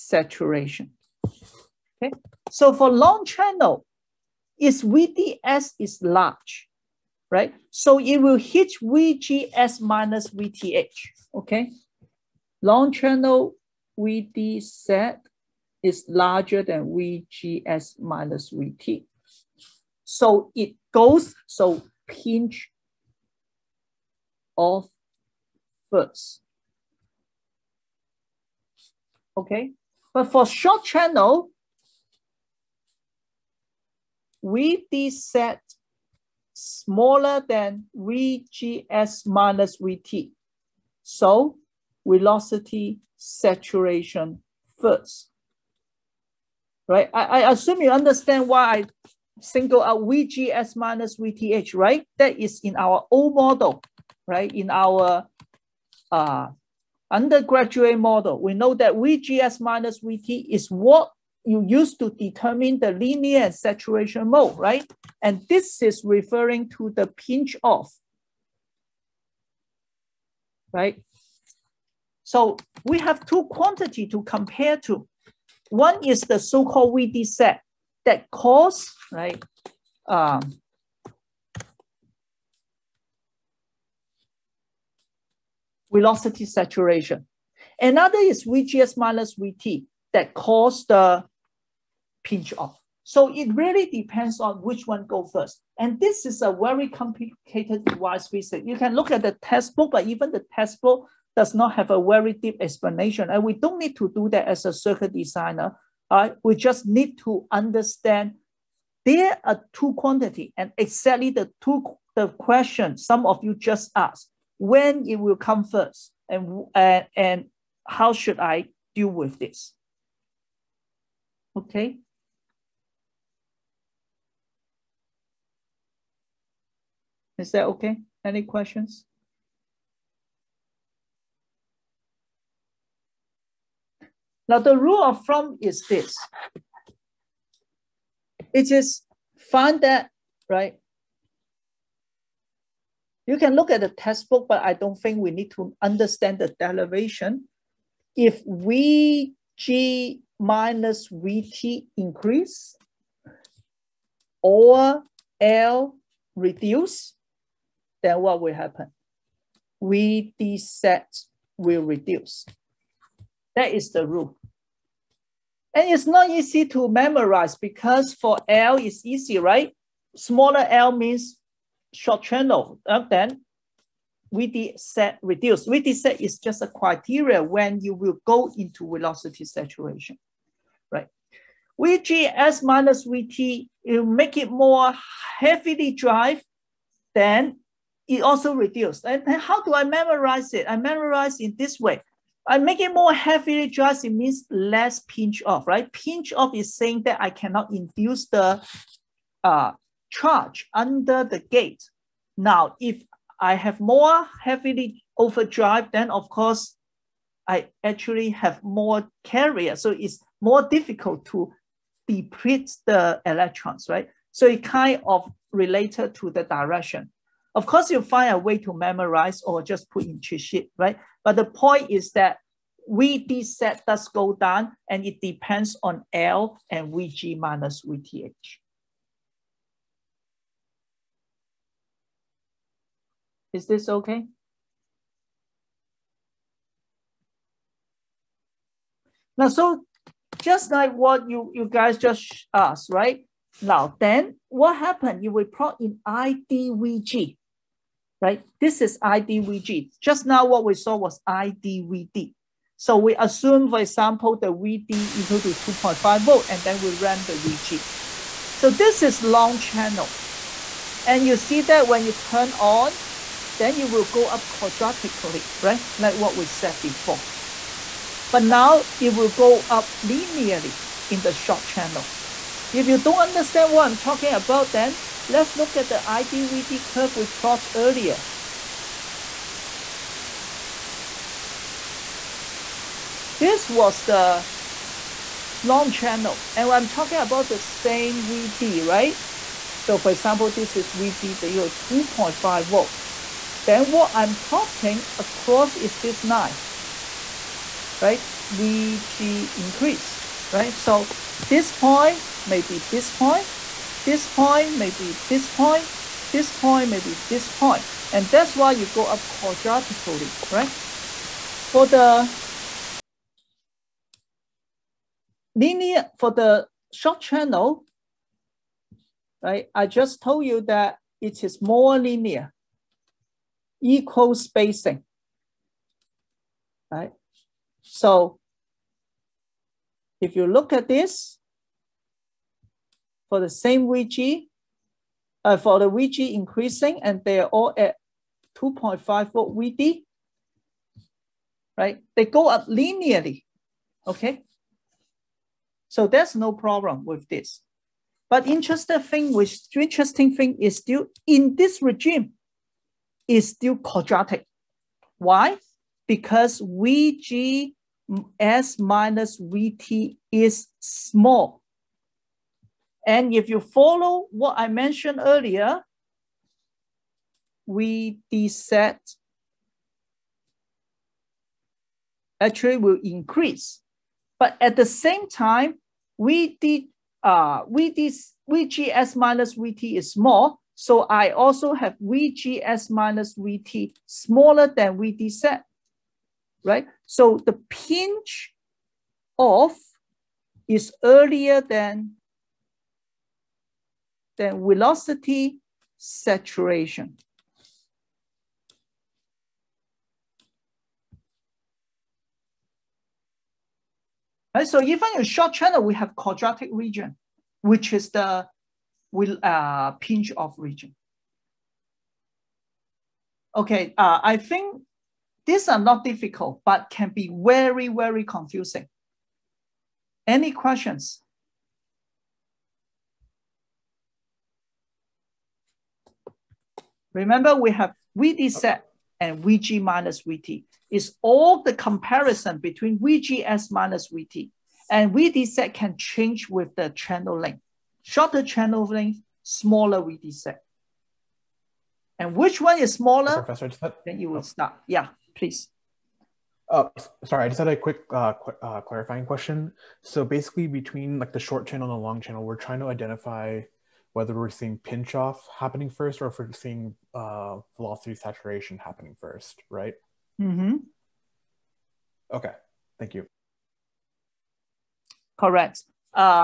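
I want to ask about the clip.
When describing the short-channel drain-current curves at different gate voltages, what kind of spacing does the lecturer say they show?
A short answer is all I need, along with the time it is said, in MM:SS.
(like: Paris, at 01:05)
equal spacing, at 05:23.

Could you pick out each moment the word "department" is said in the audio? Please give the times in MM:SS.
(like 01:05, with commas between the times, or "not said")
not said.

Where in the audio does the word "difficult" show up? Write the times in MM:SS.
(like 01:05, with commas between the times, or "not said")
03:30, 06:56.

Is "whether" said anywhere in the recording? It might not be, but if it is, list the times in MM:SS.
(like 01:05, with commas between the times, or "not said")
07:34.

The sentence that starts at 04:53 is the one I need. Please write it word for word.
Then what I'm plotting across is this line, right?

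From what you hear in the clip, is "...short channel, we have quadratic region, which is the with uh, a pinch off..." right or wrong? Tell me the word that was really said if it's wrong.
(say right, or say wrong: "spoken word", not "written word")
right.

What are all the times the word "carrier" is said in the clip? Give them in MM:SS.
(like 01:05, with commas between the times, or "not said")
03:29.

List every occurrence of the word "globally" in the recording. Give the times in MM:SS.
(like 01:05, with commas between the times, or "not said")
not said.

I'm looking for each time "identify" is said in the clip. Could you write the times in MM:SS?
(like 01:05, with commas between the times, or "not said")
07:32.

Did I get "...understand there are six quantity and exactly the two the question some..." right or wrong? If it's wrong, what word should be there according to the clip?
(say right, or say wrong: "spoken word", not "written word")
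wrong: "two", not "six".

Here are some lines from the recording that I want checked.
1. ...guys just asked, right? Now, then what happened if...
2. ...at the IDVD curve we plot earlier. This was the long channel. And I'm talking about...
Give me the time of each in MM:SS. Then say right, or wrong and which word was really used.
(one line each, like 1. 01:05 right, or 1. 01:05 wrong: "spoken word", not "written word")
1. 04:01 right
2. 04:35 right.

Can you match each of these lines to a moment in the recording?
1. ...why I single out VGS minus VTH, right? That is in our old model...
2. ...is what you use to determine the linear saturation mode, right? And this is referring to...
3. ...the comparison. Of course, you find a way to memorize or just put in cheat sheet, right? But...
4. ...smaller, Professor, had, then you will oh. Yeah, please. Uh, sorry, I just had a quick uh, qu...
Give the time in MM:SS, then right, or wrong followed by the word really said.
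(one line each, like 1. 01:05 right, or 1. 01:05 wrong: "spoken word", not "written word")
1. 00:48 right
2. 01:00 right
3. 03:36 wrong: "direction", not "comparison"
4. 07:22 right.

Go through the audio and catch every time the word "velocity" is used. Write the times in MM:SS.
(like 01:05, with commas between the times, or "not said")
00:42, 01:25, 02:58, 06:34, 07:37.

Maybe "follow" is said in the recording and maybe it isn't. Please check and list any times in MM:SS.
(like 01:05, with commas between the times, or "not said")
06:03.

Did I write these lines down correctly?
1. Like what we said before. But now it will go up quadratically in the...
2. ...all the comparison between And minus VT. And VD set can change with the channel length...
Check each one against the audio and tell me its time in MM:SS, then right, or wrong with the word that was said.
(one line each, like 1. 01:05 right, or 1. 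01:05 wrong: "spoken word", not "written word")
1. 04:25 wrong: "linearly", not "quadratically"
2. 07:11 wrong: "VGS", not "And".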